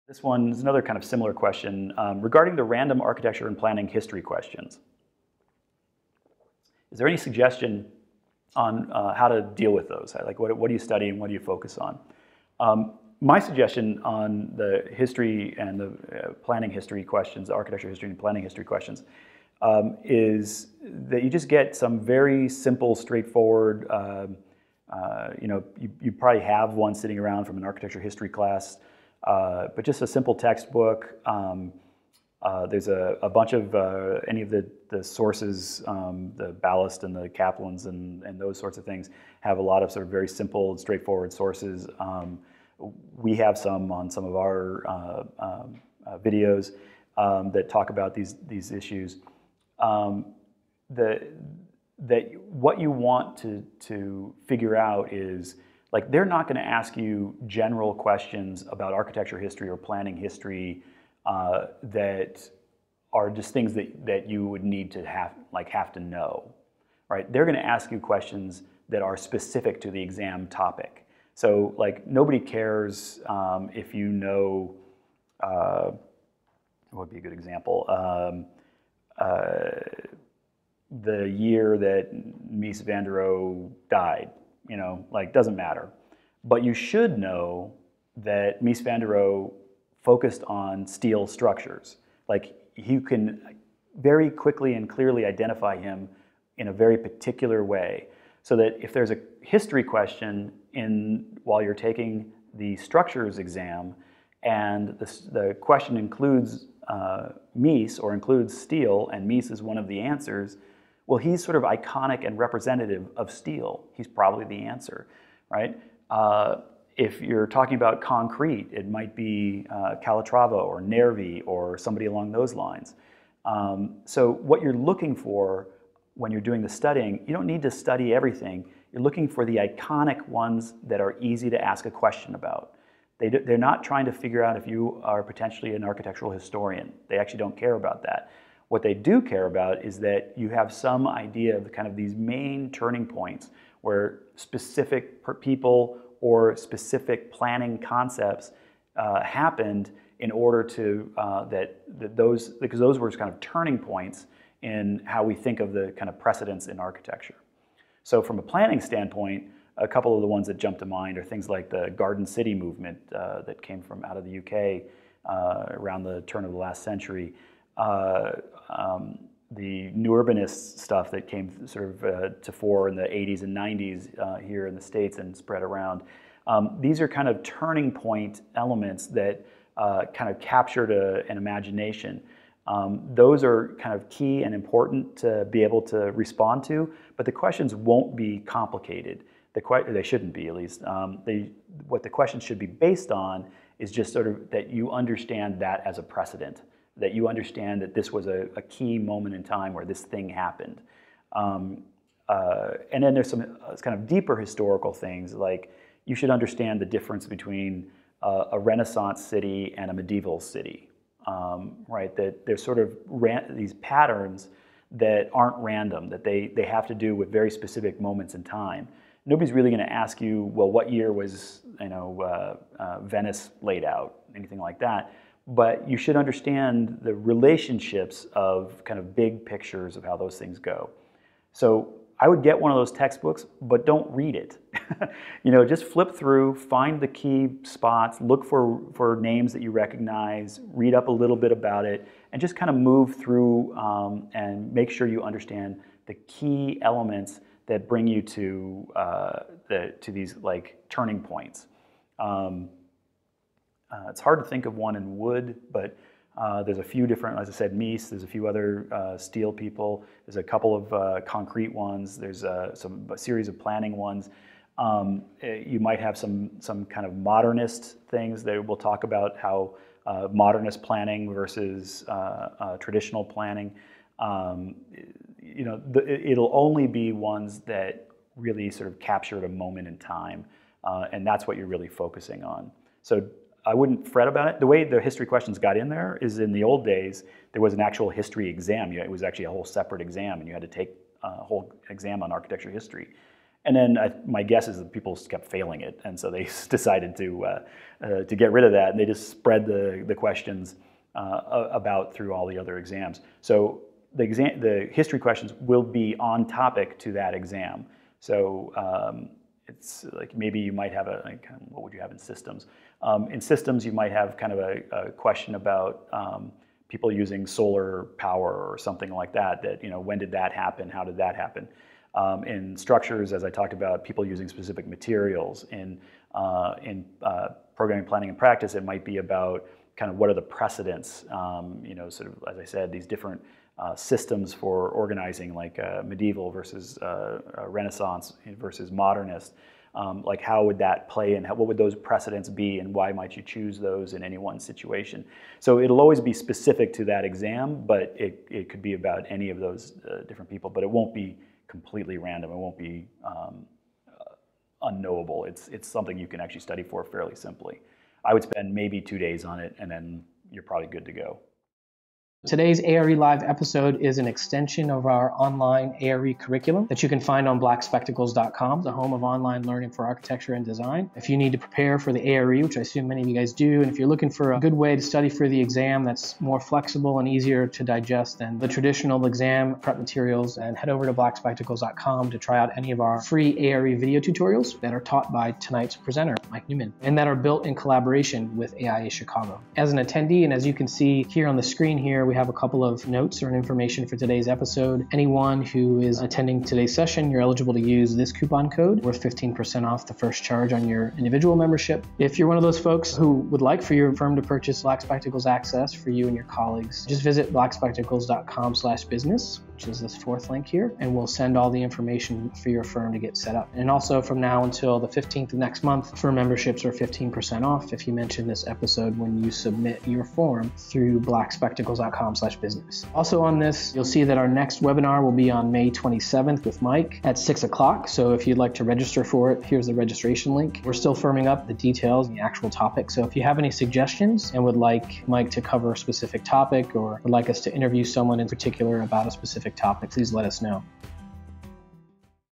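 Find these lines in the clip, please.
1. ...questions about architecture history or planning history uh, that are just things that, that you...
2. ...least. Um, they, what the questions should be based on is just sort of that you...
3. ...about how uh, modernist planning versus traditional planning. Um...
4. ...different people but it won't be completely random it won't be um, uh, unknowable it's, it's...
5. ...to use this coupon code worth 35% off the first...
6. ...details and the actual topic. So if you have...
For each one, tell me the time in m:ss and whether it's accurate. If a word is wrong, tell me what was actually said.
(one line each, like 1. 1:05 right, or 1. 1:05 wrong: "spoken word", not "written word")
1. 0:57 right
2. 3:10 right
3. 4:29 right
4. 5:50 right
5. 6:37 wrong: "15", not "35"
6. 7:11 right.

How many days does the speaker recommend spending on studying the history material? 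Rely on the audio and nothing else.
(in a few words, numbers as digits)
2.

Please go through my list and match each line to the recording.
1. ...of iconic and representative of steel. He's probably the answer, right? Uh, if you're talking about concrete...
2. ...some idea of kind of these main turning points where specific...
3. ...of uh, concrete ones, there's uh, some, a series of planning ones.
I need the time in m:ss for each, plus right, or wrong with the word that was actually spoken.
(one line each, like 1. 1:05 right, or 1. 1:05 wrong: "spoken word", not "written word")
1. 1:51 right
2. 2:20 right
3. 4:20 right.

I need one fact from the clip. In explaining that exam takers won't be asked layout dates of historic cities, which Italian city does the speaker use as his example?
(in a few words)
Venice.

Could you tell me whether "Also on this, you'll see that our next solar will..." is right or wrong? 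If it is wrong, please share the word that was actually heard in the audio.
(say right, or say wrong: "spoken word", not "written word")
wrong: "webinar", not "solar".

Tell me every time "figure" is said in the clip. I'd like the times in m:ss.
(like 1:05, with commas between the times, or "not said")
0:54, 2:14.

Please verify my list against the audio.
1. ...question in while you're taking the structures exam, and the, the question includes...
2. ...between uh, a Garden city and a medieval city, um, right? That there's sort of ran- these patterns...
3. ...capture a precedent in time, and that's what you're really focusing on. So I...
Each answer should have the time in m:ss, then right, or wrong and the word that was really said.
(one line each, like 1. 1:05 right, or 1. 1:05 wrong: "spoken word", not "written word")
1. 1:39 right
2. 3:27 wrong: "Renaissance", not "Garden"
3. 4:38 wrong: "moment", not "precedent".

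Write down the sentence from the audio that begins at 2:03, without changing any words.
Um, so what you're looking for when you're doing the studying, you don't need to study everything.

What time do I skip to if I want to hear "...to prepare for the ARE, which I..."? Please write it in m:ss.
6:11.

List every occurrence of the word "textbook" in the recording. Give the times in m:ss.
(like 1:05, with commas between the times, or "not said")
0:30, 3:52.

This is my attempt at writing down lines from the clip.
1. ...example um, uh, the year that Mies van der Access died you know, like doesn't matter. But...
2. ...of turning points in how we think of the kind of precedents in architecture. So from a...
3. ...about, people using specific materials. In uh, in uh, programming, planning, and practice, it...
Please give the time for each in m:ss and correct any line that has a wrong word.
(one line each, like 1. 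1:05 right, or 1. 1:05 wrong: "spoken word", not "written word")
1. 1:17 wrong: "Rohe", not "Access"
2. 2:33 right
3. 5:23 right.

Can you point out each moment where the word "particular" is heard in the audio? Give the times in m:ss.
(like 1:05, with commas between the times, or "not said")
1:36, 7:18.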